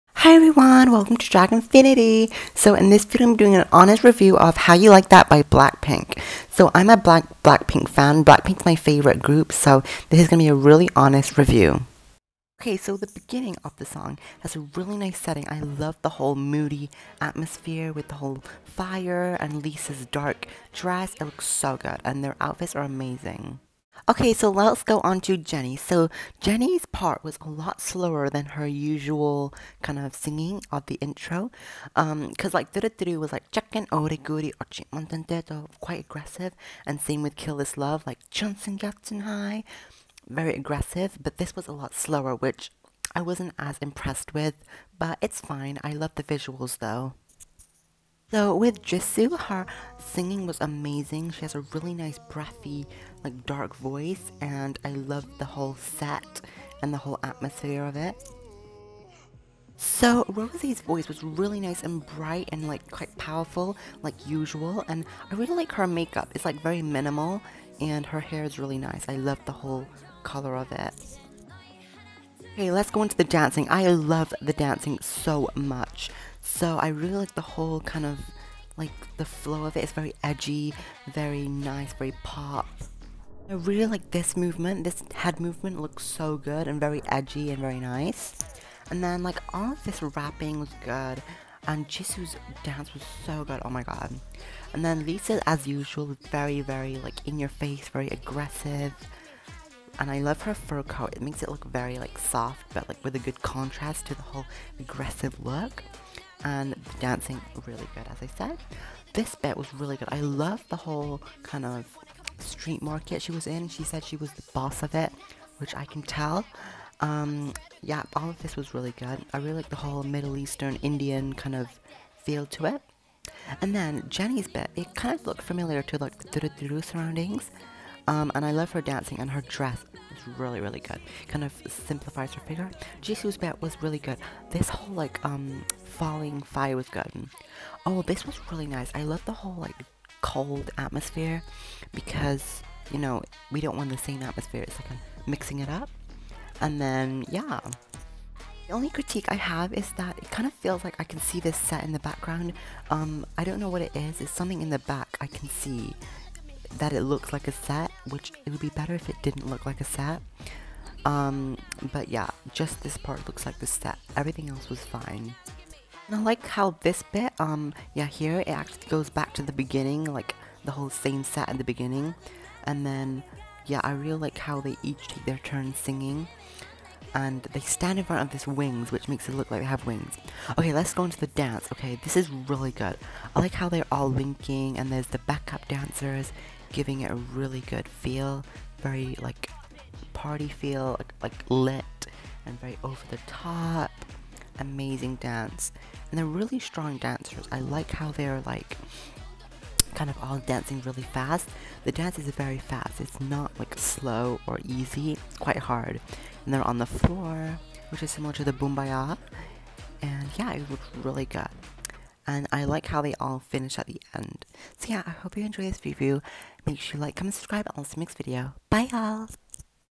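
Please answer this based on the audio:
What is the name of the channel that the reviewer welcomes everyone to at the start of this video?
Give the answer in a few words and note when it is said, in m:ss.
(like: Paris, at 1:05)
Dragonfinity, at 0:01.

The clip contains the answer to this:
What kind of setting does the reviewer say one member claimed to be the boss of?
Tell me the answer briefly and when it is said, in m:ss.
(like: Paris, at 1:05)
Street market, at 1:52.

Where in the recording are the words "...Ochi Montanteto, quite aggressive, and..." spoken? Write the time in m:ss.
0:34.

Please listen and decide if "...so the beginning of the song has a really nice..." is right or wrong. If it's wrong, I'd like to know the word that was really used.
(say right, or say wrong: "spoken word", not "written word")
right.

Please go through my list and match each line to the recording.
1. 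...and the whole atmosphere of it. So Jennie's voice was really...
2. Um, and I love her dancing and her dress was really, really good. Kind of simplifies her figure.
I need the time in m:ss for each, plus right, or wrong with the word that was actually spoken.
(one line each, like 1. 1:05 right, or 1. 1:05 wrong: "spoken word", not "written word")
1. 0:56 wrong: "Rosie", not "Jennie"
2. 2:08 right.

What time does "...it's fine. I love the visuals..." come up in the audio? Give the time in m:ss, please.
0:45.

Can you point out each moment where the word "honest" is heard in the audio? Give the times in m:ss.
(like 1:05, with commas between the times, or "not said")
0:03, 0:10.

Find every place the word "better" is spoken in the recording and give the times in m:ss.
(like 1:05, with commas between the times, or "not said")
2:38.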